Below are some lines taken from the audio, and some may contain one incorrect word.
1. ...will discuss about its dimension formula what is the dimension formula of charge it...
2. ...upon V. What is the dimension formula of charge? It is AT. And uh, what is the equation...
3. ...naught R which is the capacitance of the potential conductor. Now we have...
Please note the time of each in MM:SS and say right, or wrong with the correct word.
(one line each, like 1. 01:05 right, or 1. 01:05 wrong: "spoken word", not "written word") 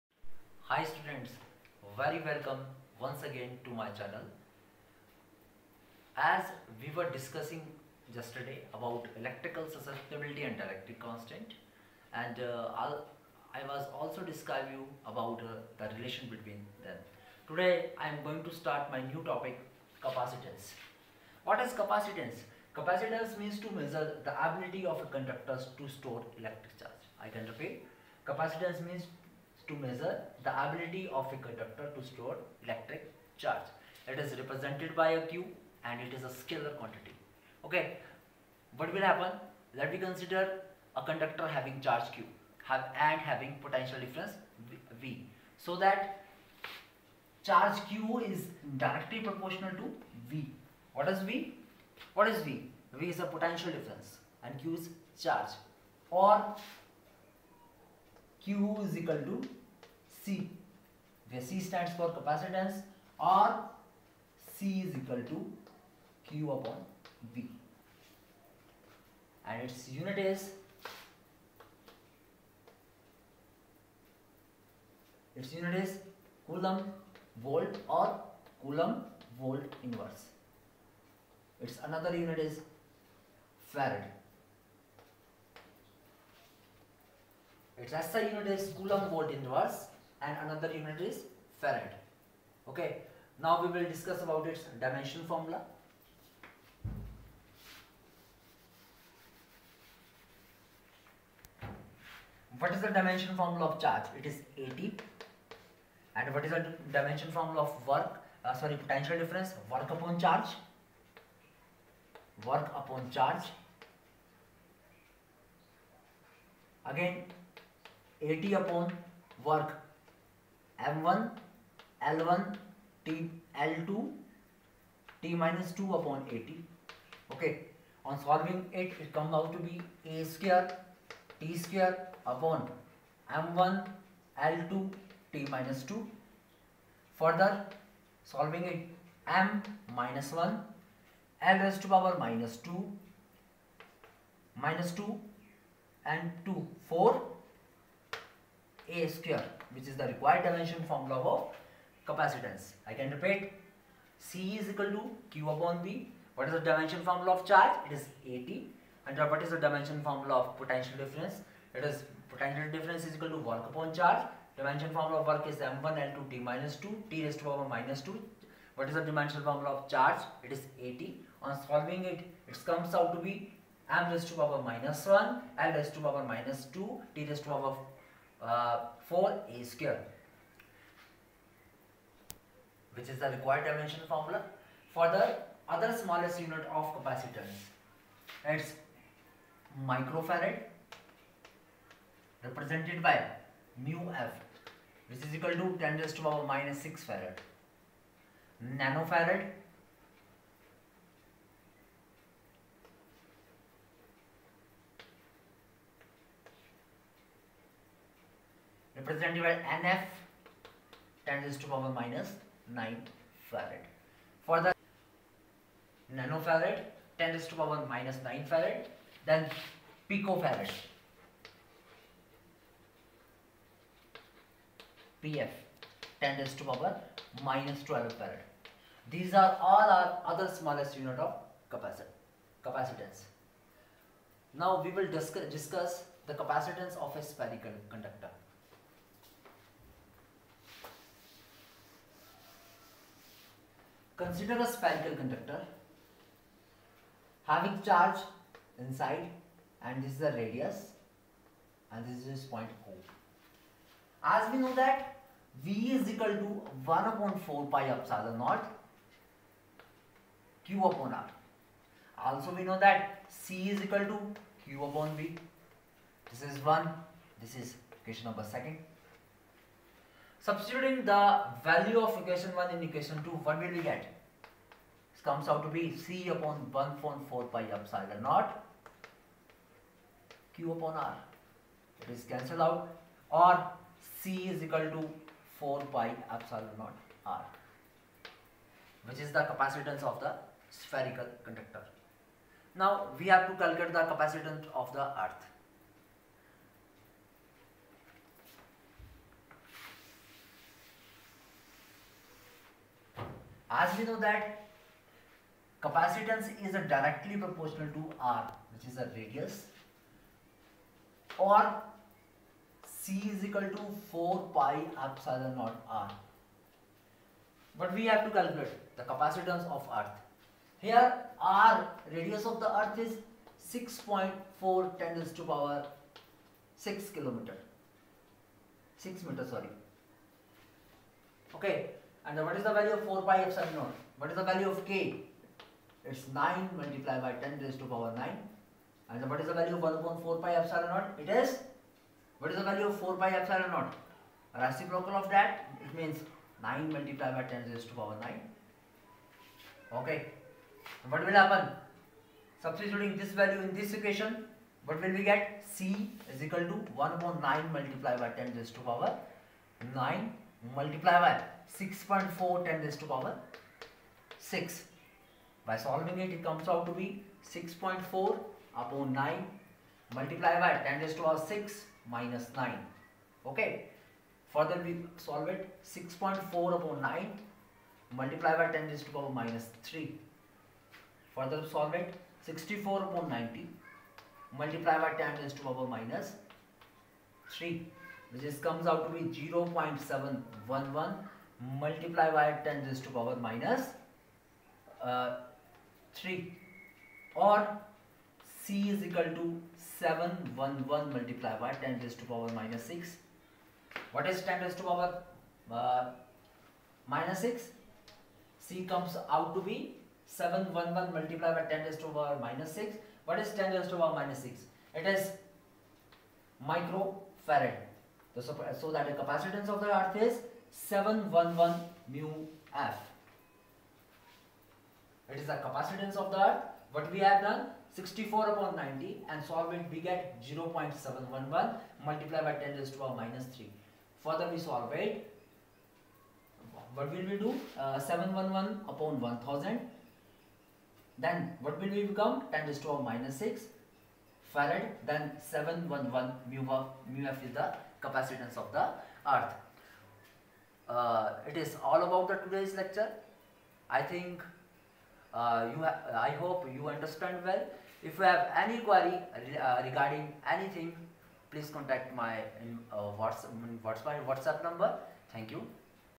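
1. 01:33 right
2. 02:35 wrong: "dimension", not "equation"
3. 04:46 wrong: "spherical", not "potential".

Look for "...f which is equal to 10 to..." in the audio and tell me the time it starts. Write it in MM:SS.
03:14.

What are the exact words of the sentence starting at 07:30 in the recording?
Uh, it is all about the today's lecture.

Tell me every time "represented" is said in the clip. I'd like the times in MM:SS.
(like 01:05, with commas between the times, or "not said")
00:34, 03:12, 03:29.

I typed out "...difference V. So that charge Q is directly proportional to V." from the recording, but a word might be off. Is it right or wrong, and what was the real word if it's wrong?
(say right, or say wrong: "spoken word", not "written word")
right.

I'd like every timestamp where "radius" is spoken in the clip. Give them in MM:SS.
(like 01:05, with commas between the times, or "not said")
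04:10, 05:09, 05:22.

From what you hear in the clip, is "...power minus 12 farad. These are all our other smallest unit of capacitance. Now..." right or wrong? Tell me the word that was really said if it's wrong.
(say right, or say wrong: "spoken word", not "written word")
right.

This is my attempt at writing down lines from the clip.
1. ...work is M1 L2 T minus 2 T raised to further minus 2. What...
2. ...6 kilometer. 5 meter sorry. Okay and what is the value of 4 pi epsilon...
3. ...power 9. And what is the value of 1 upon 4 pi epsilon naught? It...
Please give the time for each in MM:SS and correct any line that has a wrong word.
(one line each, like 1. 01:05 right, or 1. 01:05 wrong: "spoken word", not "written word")
1. 02:45 wrong: "power", not "further"
2. 05:26 wrong: "6", not "5"
3. 05:37 right.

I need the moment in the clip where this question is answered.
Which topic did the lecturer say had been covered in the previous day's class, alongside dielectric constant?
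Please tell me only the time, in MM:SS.
00:09.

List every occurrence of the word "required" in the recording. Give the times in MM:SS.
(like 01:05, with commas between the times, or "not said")
02:30, 03:03.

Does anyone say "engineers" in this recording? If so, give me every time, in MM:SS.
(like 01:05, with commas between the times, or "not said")
not said.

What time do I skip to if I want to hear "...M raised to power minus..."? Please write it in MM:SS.
02:53.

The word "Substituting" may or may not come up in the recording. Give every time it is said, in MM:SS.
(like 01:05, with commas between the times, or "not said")
04:30, 05:52.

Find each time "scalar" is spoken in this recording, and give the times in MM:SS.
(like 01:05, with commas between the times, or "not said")
00:36.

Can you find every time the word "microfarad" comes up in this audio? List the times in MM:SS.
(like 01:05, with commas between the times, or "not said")
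03:09, 06:56.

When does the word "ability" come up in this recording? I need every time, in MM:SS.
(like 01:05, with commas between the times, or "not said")
00:24, 00:30.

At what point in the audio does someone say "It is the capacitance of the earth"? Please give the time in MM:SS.
07:05.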